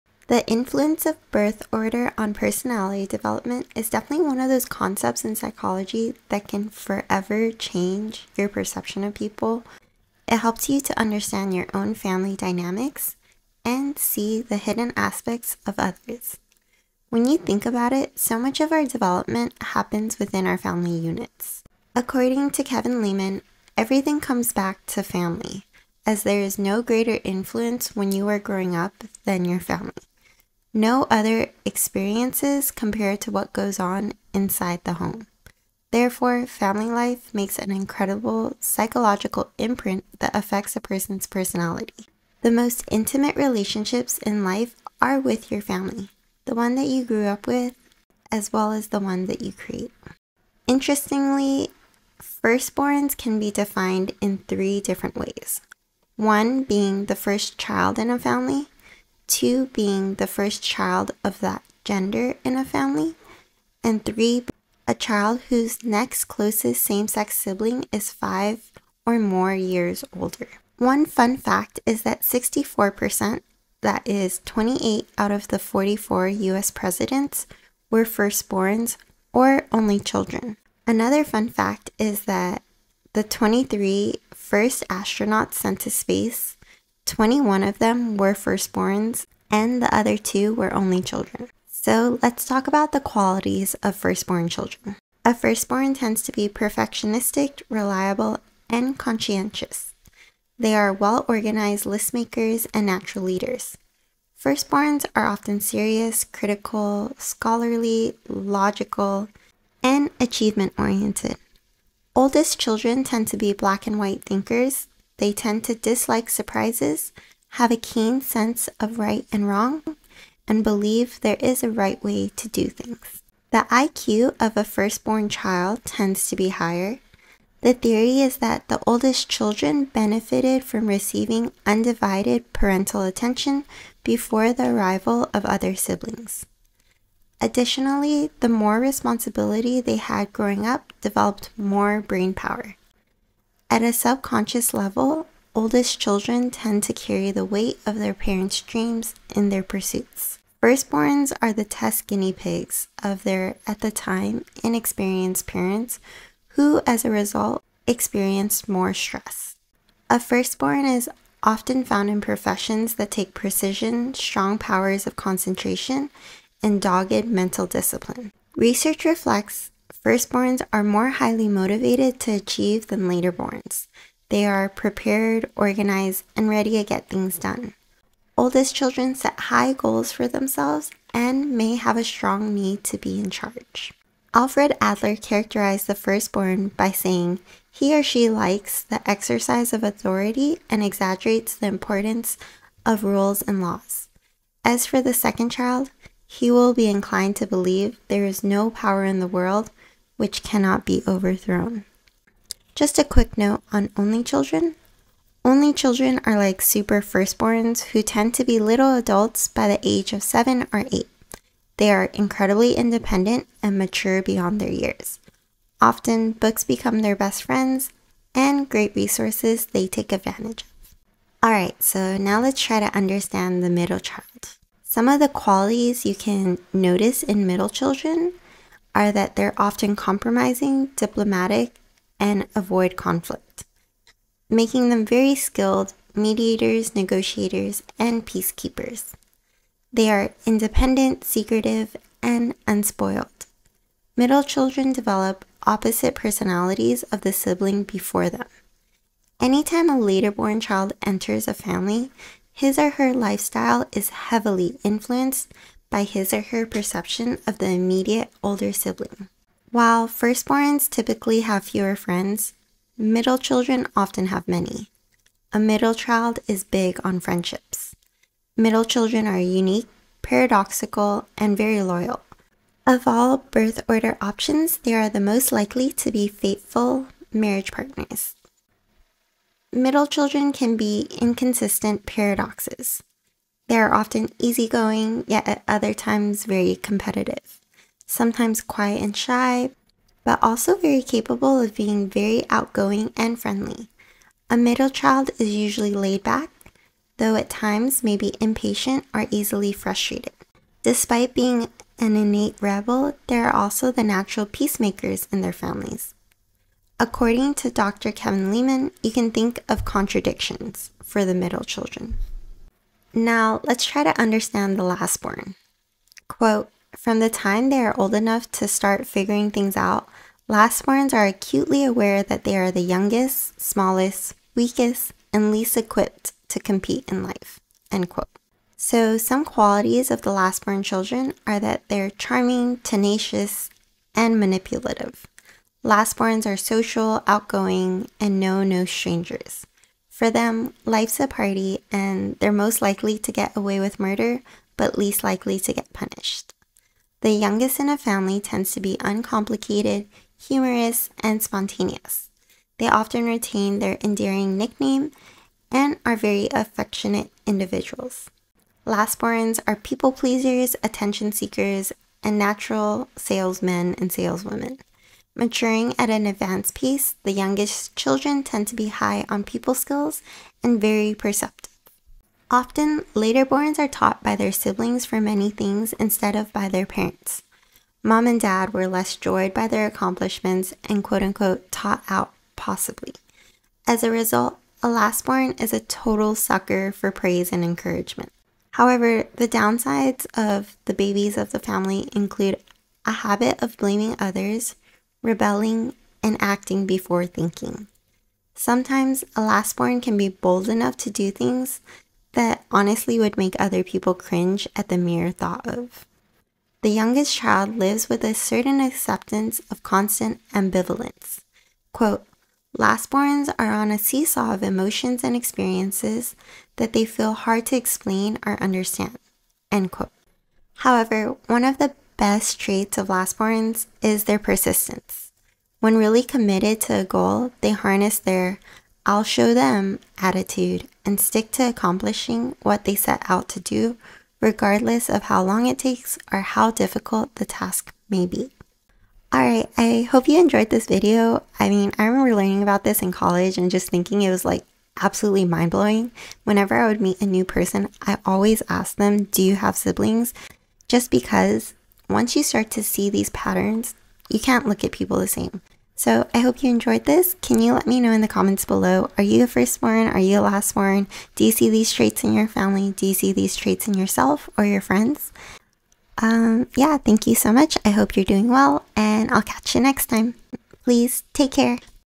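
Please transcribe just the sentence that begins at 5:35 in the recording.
Lastborns are social, outgoing, and know no strangers.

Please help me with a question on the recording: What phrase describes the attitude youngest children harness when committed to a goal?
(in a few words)
I'll show them.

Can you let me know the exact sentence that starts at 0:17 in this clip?
When you think about it, so much of our development happens within our family units.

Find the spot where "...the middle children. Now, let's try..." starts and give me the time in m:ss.
5:11.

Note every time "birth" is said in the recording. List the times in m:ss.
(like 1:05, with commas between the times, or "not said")
0:01, 4:33.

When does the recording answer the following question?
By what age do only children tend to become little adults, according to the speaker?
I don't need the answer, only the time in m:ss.
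3:30.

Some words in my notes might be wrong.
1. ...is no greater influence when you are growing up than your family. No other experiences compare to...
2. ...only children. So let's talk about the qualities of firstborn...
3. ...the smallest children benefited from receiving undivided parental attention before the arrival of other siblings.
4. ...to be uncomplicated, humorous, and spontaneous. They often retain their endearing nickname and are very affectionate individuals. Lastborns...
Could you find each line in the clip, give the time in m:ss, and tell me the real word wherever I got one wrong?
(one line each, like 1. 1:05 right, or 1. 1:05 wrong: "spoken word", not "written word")
1. 0:26 right
2. 1:30 right
3. 2:08 wrong: "oldest", not "smallest"
4. 5:48 right.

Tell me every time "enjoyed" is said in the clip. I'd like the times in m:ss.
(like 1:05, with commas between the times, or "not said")
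7:20, 7:36.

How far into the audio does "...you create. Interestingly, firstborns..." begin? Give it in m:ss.
0:49.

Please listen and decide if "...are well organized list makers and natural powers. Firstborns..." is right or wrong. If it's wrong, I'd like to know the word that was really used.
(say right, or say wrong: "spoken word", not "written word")
wrong: "leaders", not "powers".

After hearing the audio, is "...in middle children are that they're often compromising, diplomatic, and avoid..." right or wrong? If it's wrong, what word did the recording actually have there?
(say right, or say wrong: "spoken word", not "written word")
right.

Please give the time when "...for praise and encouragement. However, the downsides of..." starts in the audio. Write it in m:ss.
6:26.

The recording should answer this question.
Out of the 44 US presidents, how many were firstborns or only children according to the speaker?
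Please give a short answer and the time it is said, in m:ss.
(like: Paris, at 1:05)
28, at 1:14.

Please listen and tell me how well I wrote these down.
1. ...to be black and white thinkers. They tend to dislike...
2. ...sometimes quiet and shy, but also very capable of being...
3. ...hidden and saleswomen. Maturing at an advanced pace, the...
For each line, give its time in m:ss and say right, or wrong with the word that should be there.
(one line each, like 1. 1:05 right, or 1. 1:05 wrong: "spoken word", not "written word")
1. 1:53 right
2. 4:48 right
3. 6:03 wrong: "salesmen", not "hidden".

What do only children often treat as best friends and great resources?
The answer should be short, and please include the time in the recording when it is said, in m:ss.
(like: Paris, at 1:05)
Books, at 3:36.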